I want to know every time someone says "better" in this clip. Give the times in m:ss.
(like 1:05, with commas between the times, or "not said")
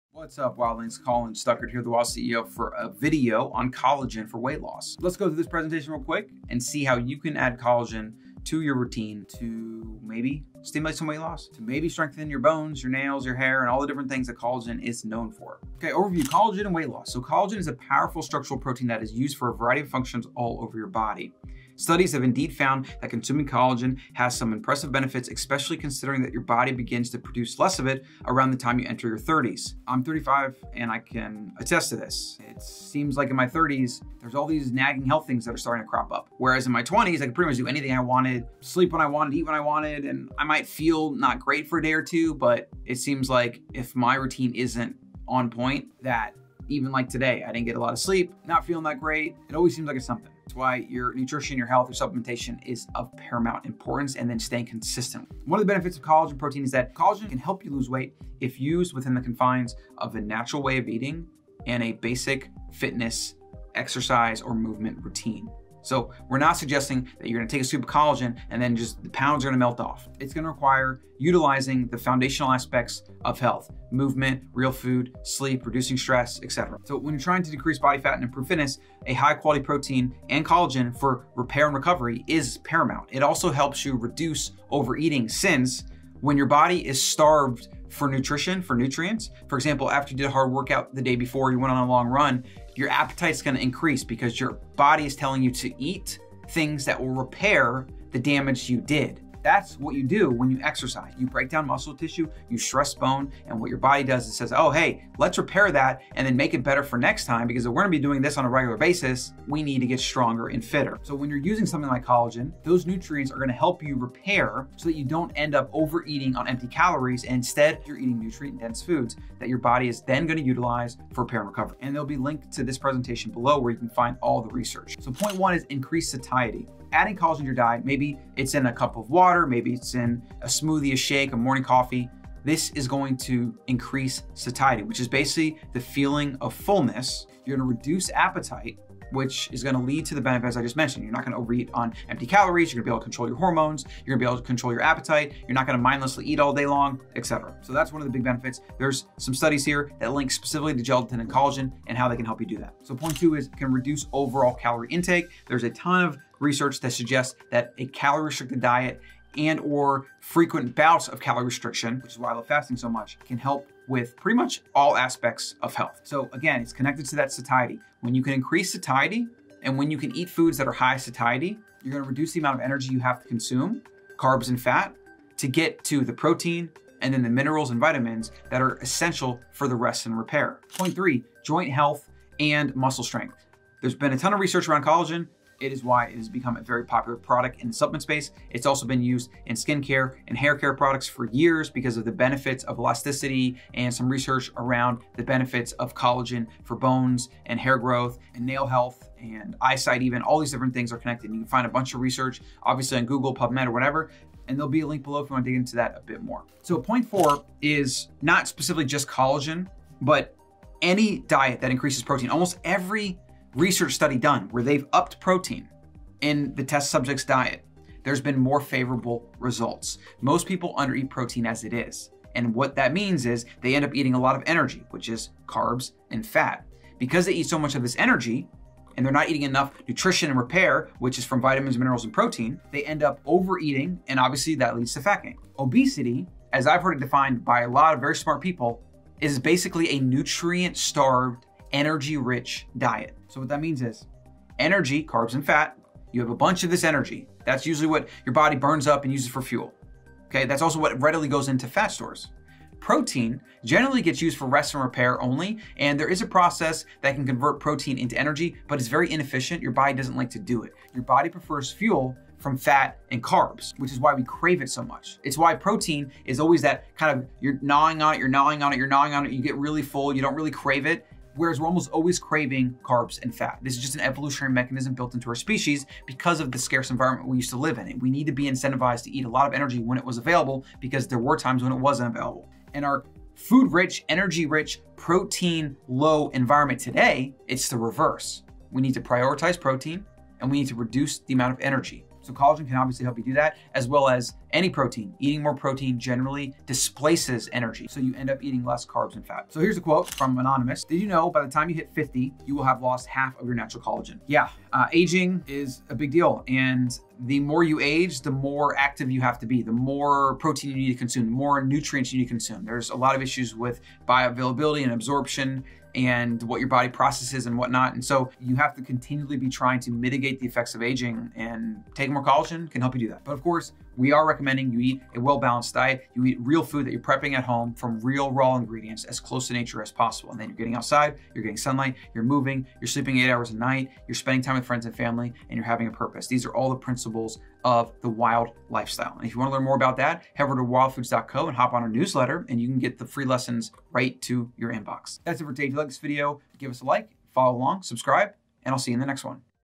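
1:46.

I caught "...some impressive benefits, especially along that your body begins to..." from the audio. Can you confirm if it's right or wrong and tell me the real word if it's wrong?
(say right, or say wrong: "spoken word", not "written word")
wrong: "considering", not "along".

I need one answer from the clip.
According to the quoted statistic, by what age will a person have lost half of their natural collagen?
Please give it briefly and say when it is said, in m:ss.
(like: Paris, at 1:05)
50, at 5:01.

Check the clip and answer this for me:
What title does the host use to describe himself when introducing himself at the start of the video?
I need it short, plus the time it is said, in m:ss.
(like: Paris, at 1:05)
the Wild CEO, at 0:01.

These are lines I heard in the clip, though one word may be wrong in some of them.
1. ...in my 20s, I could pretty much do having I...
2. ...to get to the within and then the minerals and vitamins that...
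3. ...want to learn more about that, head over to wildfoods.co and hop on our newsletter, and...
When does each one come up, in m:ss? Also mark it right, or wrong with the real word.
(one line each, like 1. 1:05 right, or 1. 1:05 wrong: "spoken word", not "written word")
1. 0:36 wrong: "anything", not "having"
2. 2:55 wrong: "protein", not "within"
3. 5:39 right.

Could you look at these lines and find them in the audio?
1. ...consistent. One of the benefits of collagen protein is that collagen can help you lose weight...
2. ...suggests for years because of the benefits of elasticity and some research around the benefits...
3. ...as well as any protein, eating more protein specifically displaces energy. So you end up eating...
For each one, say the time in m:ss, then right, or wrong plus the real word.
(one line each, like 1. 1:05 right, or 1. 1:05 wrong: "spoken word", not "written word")
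1. 0:54 right
2. 3:10 wrong: "products", not "suggests"
3. 4:53 wrong: "generally", not "specifically".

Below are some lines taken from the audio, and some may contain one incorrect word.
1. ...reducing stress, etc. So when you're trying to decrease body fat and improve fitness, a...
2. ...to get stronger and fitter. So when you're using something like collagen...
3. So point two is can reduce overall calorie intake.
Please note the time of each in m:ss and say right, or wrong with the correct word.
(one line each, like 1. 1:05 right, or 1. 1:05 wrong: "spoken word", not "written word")
1. 1:15 right
2. 1:49 right
3. 2:32 right.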